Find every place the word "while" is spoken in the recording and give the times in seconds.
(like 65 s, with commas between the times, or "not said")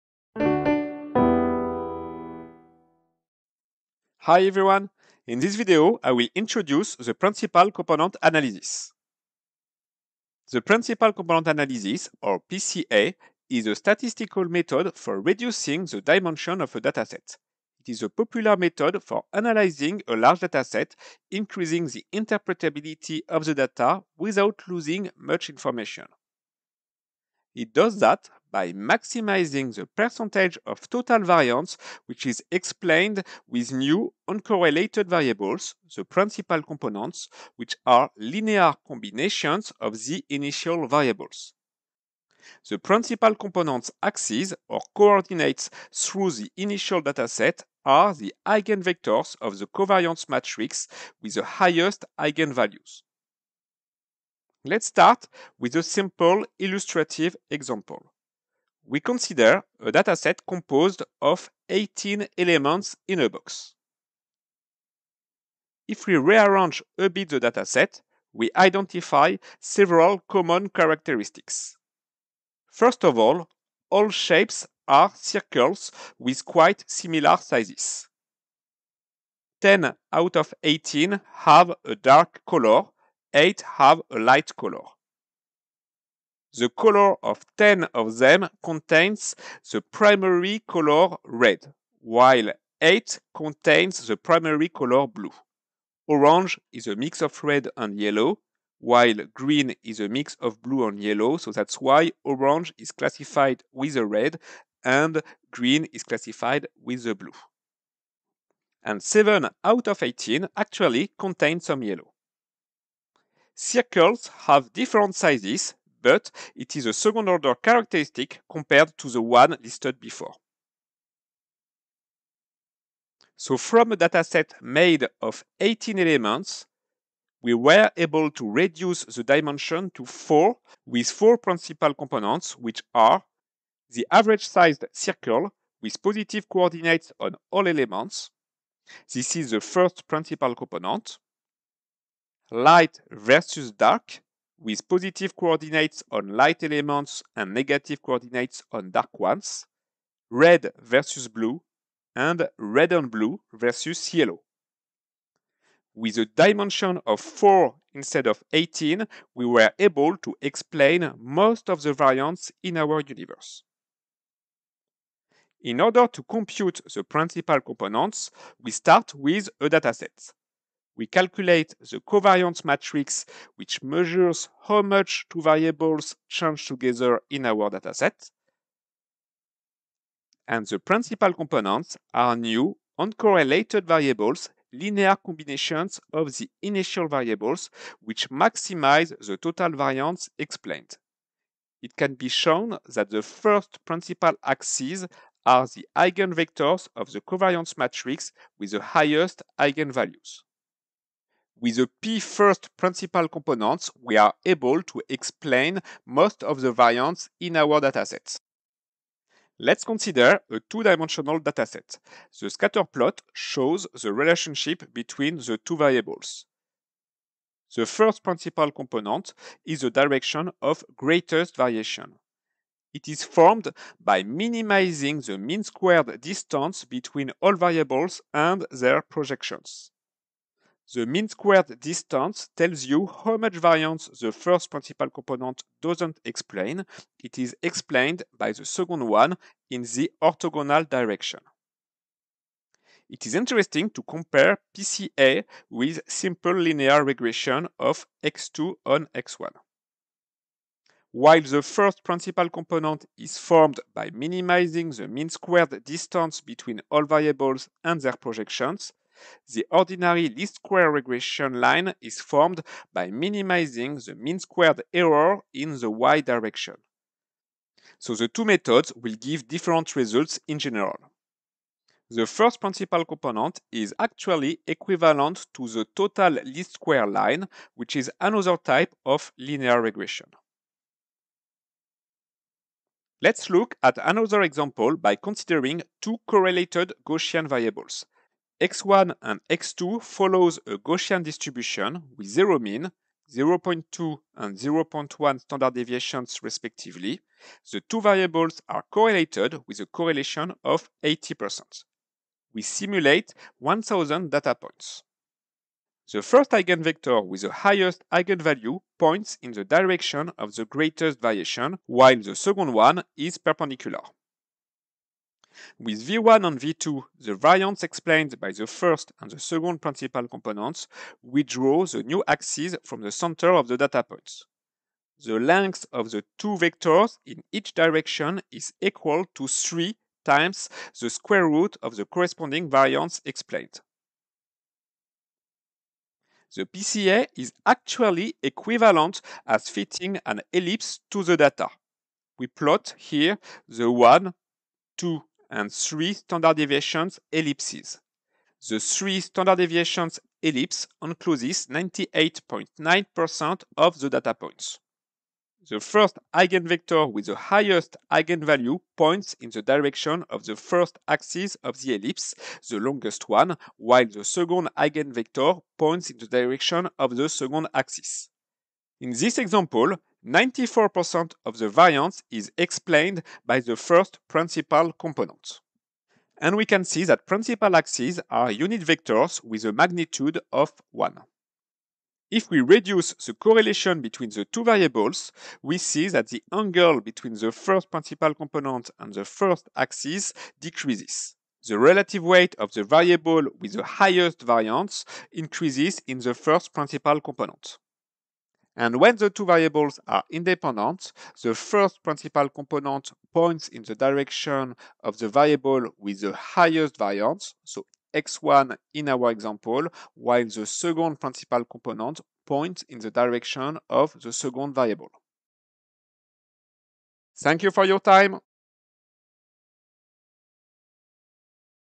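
92 s, 98 s, 251 s, 311 s, 363 s, 410 s.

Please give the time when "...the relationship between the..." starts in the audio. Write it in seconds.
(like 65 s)
214 s.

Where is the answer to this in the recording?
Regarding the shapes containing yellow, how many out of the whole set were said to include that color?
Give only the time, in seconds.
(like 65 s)
109 s.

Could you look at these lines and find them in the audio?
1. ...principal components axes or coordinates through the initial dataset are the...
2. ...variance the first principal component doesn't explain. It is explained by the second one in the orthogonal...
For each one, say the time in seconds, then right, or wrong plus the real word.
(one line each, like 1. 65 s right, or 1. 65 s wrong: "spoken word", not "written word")
1. 42 s right
2. 233 s right.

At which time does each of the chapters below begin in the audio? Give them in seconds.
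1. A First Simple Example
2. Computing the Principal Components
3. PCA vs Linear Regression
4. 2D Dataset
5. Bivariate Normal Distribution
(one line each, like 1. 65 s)
1. 54 s
2. 164 s
3. 243 s
4. 209 s
5. 282 s.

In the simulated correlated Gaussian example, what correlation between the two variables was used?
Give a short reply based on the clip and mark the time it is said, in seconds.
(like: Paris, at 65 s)
80%, at 301 s.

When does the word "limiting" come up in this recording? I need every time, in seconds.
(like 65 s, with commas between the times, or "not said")
not said.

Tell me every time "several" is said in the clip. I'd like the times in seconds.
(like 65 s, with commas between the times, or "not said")
69 s.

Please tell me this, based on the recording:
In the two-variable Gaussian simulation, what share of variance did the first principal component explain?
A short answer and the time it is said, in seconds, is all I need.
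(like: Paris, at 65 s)
94%, at 370 s.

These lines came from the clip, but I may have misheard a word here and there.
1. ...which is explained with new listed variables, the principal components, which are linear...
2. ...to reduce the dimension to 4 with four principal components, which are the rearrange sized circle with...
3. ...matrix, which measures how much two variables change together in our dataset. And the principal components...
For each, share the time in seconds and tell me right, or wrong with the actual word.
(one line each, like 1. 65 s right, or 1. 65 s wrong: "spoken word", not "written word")
1. 32 s wrong: "uncorrelated", not "listed"
2. 128 s wrong: "average", not "rearrange"
3. 172 s right.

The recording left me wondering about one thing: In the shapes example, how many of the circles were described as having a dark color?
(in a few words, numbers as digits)
10.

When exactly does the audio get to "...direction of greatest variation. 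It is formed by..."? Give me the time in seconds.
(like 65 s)
219 s.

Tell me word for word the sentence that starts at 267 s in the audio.
So the two methods will give different results in general.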